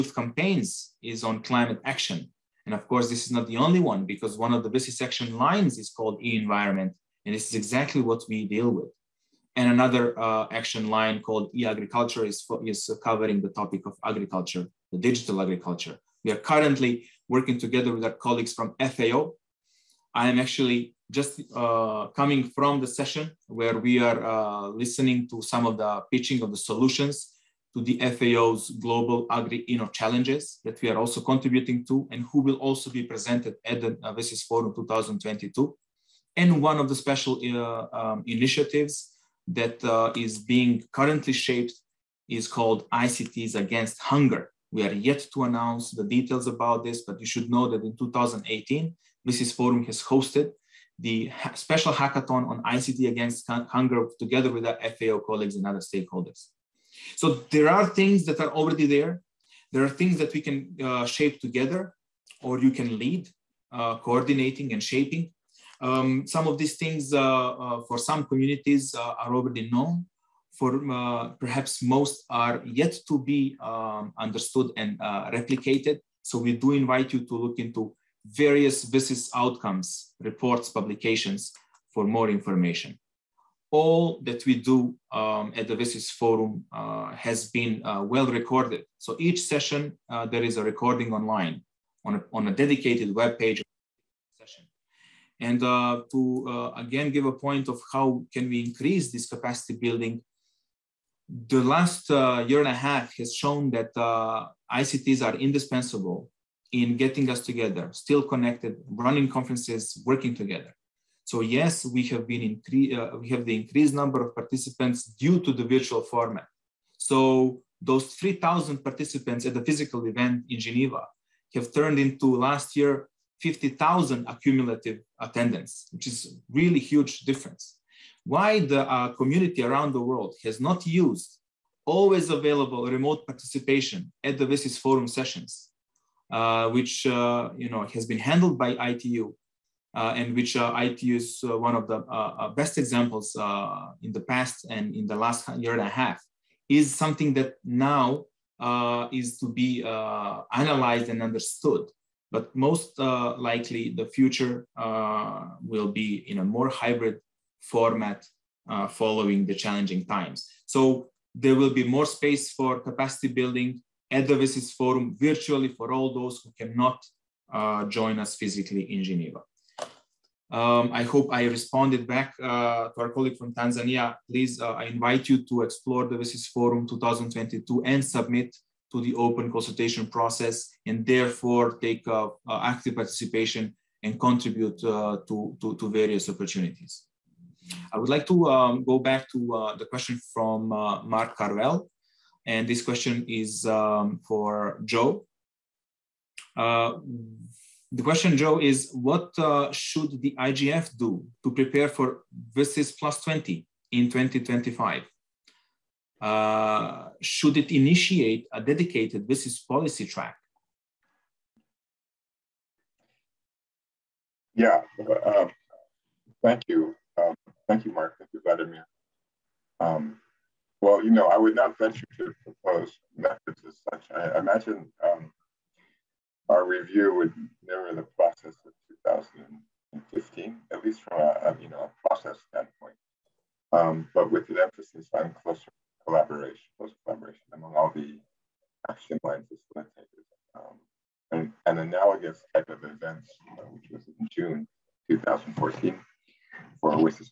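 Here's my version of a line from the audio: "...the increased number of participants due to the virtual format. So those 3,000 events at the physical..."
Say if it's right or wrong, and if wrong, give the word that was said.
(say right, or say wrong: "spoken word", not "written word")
wrong: "participants", not "events".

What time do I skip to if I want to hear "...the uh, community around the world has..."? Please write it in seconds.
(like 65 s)
128 s.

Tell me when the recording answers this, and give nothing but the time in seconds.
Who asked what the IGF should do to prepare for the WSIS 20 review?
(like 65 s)
190 s.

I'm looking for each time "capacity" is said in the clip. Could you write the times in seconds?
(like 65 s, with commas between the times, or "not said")
99 s, 162 s.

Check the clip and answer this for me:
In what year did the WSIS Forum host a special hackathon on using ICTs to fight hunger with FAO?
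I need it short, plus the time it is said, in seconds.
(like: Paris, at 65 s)
2018, at 47 s.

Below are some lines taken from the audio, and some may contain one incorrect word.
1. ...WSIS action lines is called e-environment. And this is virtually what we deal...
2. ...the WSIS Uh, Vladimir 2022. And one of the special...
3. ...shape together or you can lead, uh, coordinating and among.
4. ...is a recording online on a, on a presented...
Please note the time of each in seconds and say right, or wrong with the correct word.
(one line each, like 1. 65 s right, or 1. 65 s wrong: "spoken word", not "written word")
1. 4 s wrong: "exactly", not "virtually"
2. 33 s wrong: "Forum", not "Vladimir"
3. 61 s wrong: "shaping", not "among"
4. 90 s wrong: "dedicated", not "presented".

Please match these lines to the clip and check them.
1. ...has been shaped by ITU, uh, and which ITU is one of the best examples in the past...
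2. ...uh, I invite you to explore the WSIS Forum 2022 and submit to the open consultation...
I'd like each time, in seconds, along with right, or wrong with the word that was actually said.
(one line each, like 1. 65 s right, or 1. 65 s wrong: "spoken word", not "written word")
1. 137 s wrong: "handled", not "shaped"
2. 174 s right.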